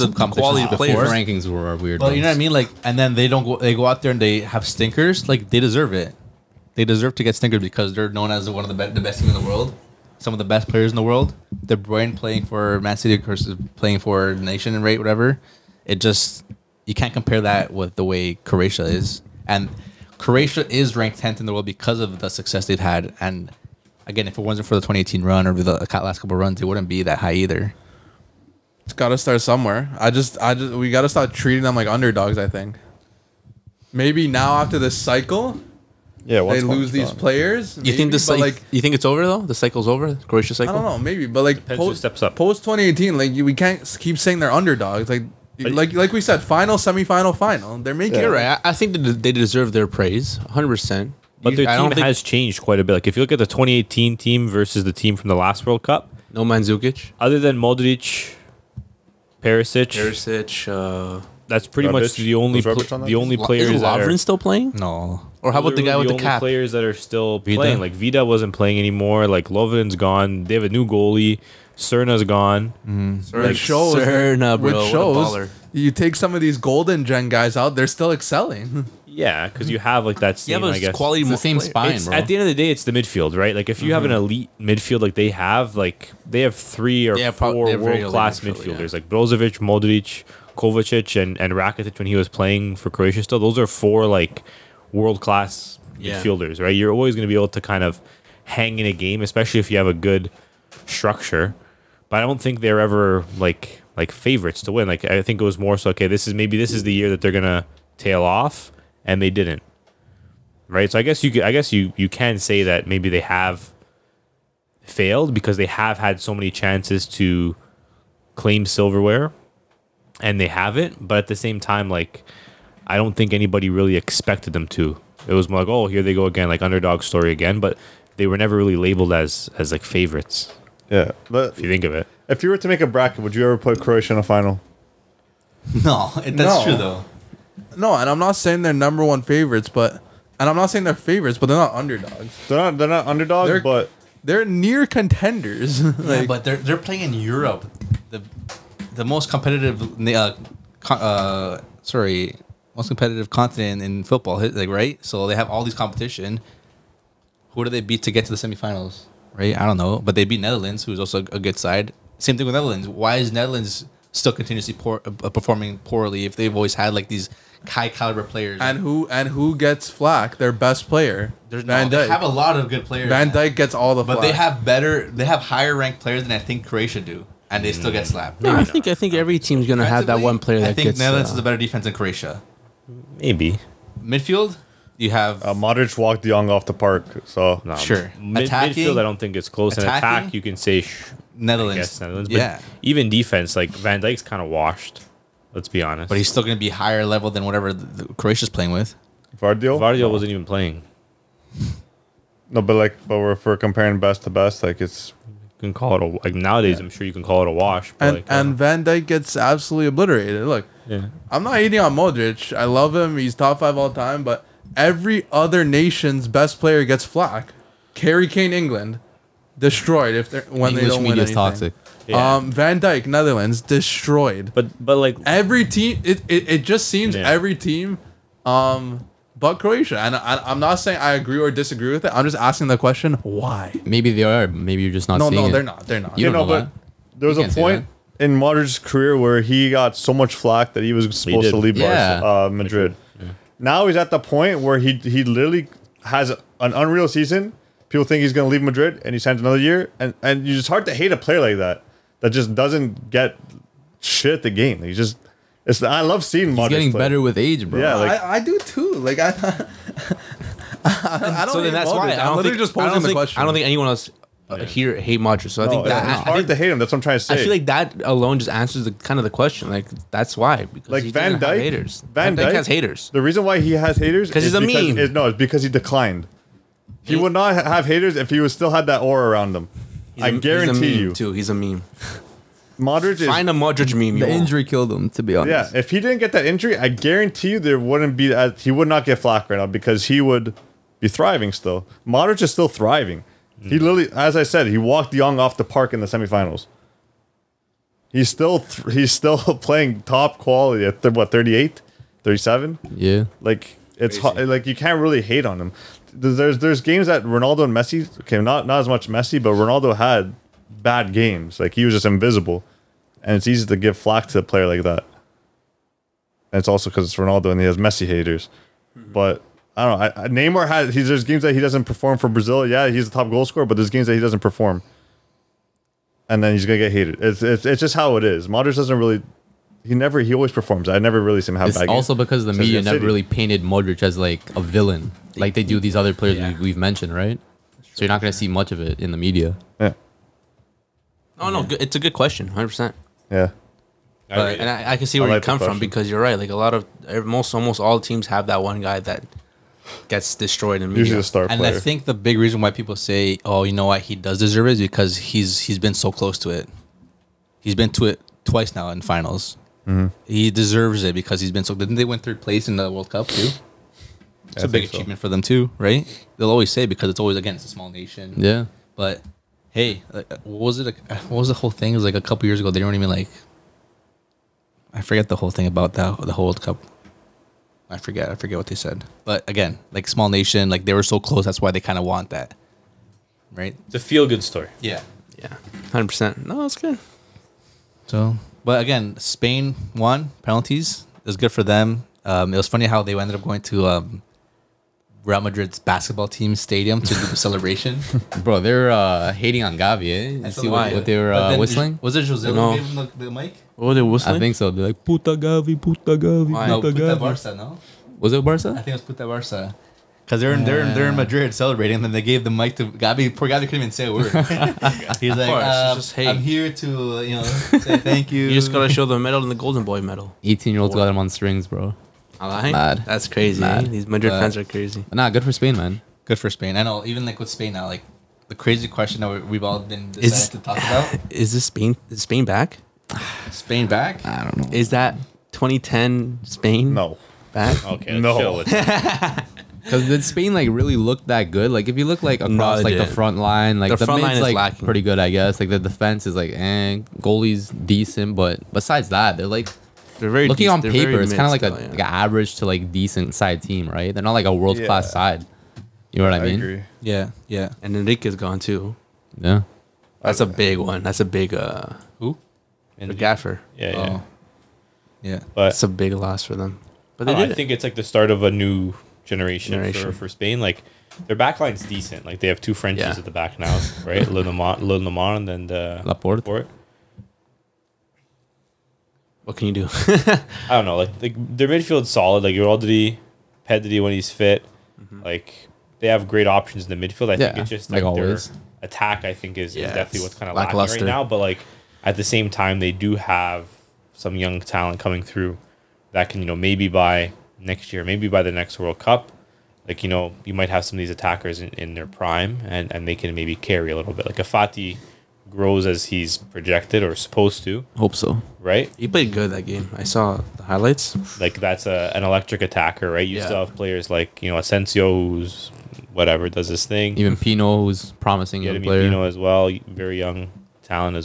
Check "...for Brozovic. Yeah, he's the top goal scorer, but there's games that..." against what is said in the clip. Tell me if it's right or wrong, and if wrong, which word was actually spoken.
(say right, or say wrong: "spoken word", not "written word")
wrong: "Brazil", not "Brozovic".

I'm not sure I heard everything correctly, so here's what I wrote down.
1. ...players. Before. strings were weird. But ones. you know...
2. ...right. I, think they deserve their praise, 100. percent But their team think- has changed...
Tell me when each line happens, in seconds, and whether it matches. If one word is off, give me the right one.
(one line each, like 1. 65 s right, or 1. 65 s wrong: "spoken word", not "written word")
1. 0 s wrong: "rankings", not "strings"
2. 48 s right.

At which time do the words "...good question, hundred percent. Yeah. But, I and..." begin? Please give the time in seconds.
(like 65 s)
341 s.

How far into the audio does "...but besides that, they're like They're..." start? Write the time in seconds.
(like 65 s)
448 s.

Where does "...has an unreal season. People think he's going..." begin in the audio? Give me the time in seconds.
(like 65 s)
246 s.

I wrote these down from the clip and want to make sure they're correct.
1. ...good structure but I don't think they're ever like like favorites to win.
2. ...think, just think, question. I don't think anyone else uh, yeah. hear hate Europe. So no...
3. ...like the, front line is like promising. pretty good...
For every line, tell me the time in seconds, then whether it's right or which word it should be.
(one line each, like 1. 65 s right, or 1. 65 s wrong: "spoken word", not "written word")
1. 99 s right
2. 262 s wrong: "Modric", not "Europe"
3. 443 s wrong: "lacking", not "promising".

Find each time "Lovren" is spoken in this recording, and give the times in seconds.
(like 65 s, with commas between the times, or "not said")
64 s, 69 s.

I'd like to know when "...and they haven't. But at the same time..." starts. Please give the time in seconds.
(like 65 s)
120 s.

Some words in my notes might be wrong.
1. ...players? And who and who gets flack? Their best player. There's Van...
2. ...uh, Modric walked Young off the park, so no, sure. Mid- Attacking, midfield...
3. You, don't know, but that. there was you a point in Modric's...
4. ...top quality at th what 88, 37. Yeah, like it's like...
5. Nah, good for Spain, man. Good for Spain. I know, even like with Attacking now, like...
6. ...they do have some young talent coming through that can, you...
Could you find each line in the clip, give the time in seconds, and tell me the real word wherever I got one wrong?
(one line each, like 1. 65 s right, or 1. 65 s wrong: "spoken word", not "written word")
1. 168 s right
2. 185 s right
3. 236 s right
4. 300 s wrong: "38", not "88"
5. 425 s wrong: "Spain", not "Attacking"
6. 492 s right.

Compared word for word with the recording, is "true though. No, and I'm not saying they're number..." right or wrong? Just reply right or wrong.
right.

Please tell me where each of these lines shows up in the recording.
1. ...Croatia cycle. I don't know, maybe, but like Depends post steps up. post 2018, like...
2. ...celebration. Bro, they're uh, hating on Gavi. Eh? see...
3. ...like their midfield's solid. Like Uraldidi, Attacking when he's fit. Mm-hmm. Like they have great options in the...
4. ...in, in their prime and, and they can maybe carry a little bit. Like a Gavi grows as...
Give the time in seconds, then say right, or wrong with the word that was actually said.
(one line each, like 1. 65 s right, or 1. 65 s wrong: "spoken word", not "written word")
1. 40 s right
2. 397 s right
3. 481 s wrong: "Pedri", not "Attacking"
4. 501 s wrong: "Fati", not "Gavi".